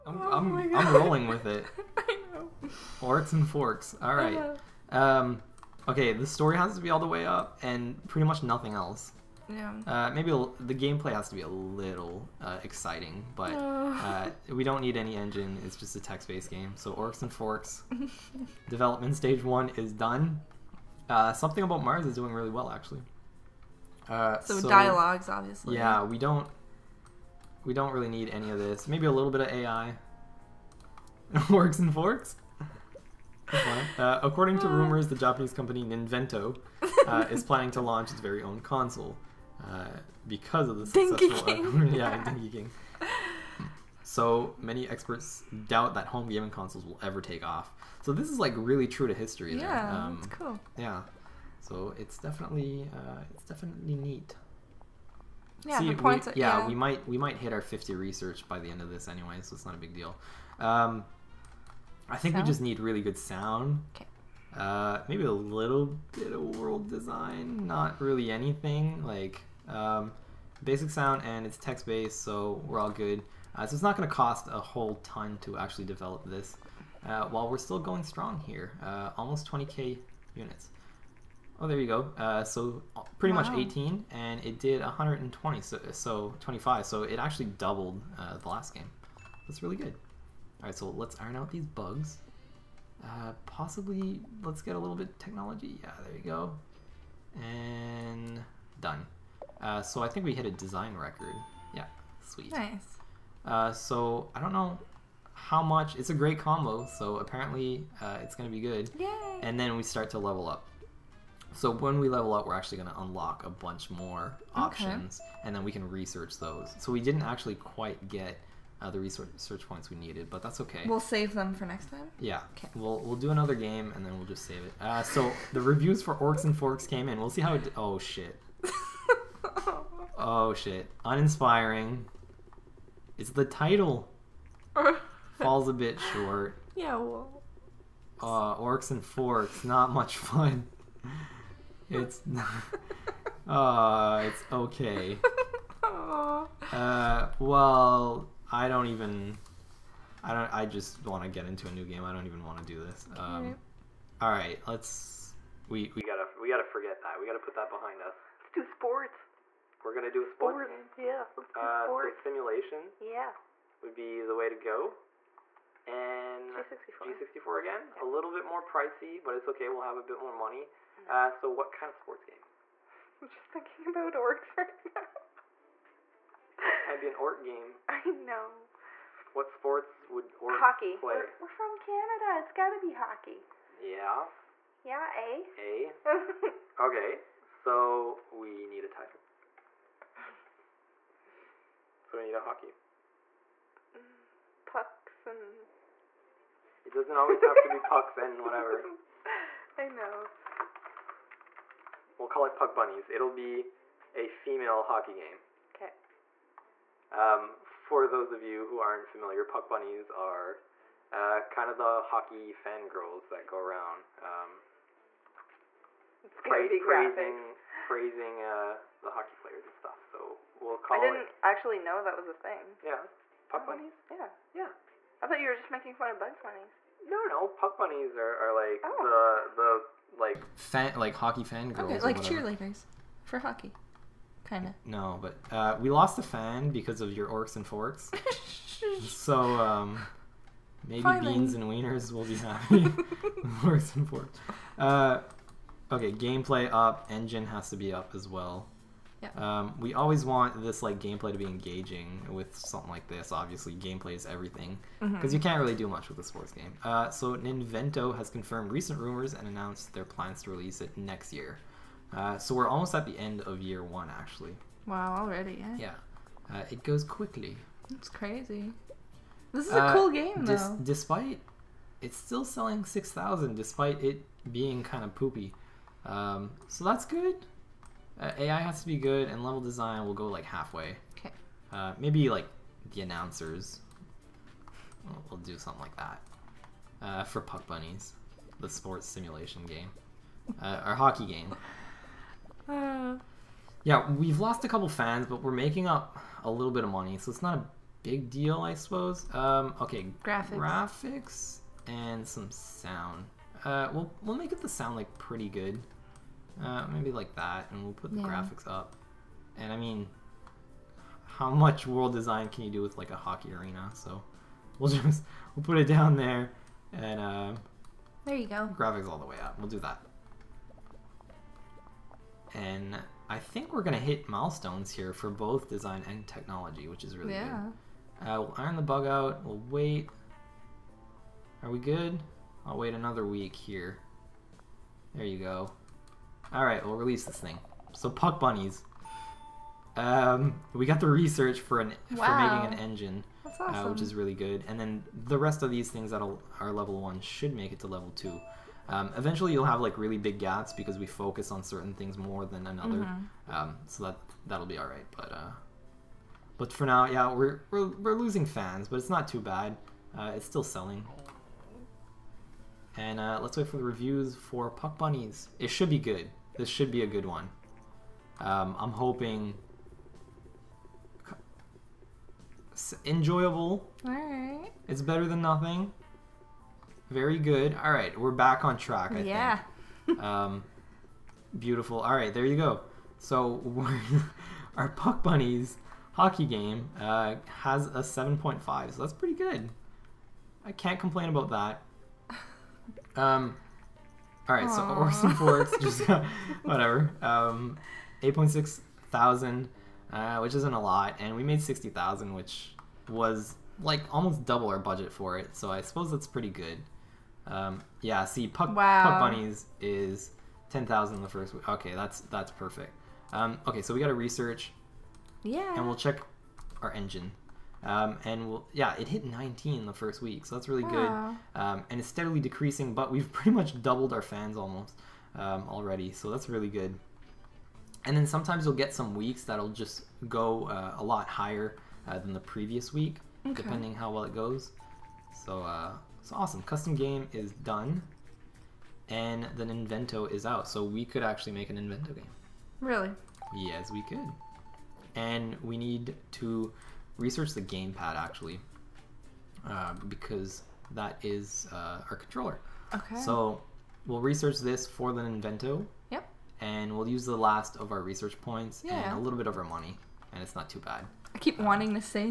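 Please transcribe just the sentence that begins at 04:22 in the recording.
Uh, so we're almost at the end of year one, actually.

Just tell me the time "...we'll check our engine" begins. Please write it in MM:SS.
06:55.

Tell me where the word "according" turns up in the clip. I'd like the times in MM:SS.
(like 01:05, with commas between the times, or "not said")
00:34.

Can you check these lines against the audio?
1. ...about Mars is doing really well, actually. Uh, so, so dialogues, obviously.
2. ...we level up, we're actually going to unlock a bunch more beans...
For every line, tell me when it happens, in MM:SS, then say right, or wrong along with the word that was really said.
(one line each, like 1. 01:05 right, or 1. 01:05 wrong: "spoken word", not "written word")
1. 00:21 right
2. 01:51 wrong: "options", not "beans".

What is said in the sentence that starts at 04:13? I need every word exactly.
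Obviously, gameplay is everything because mm-hmm.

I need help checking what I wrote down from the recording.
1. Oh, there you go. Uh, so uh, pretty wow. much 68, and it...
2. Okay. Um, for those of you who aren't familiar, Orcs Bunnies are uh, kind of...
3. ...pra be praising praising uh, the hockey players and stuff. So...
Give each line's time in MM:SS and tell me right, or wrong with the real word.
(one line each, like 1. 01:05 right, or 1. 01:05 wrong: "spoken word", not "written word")
1. 01:21 wrong: "18", not "68"
2. 03:25 wrong: "Puck", not "Orcs"
3. 03:36 right.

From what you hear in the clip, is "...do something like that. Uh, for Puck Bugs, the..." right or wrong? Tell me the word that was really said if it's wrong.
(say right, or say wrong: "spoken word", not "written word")
wrong: "Bunnies", not "Bugs".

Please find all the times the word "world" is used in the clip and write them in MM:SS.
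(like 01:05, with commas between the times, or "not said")
01:06, 05:11.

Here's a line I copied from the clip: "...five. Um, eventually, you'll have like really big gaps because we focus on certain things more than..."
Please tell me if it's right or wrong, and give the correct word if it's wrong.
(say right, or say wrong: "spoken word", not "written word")
wrong: "two", not "five".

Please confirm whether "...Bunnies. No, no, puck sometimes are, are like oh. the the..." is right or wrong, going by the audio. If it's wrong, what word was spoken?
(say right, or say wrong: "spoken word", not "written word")
wrong: "bunnies", not "sometimes".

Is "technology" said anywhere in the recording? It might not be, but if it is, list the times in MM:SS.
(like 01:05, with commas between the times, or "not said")
01:35, 05:26.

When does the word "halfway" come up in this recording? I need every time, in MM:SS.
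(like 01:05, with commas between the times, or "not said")
04:40.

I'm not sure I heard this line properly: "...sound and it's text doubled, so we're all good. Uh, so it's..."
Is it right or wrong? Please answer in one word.
wrong.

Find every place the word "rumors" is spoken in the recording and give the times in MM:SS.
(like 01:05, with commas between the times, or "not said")
00:34, 04:18.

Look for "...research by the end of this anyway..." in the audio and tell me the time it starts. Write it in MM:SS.
00:57.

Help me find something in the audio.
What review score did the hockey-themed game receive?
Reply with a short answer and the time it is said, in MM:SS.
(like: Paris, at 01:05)
7.5, at 06:28.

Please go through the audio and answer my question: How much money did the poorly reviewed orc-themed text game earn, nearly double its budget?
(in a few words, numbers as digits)
60,000.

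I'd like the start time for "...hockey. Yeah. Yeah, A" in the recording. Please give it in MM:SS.
03:02.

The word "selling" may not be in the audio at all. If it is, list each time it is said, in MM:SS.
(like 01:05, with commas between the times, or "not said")
04:32, 06:00.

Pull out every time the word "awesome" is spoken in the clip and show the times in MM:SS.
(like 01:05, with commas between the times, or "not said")
05:43, 07:16.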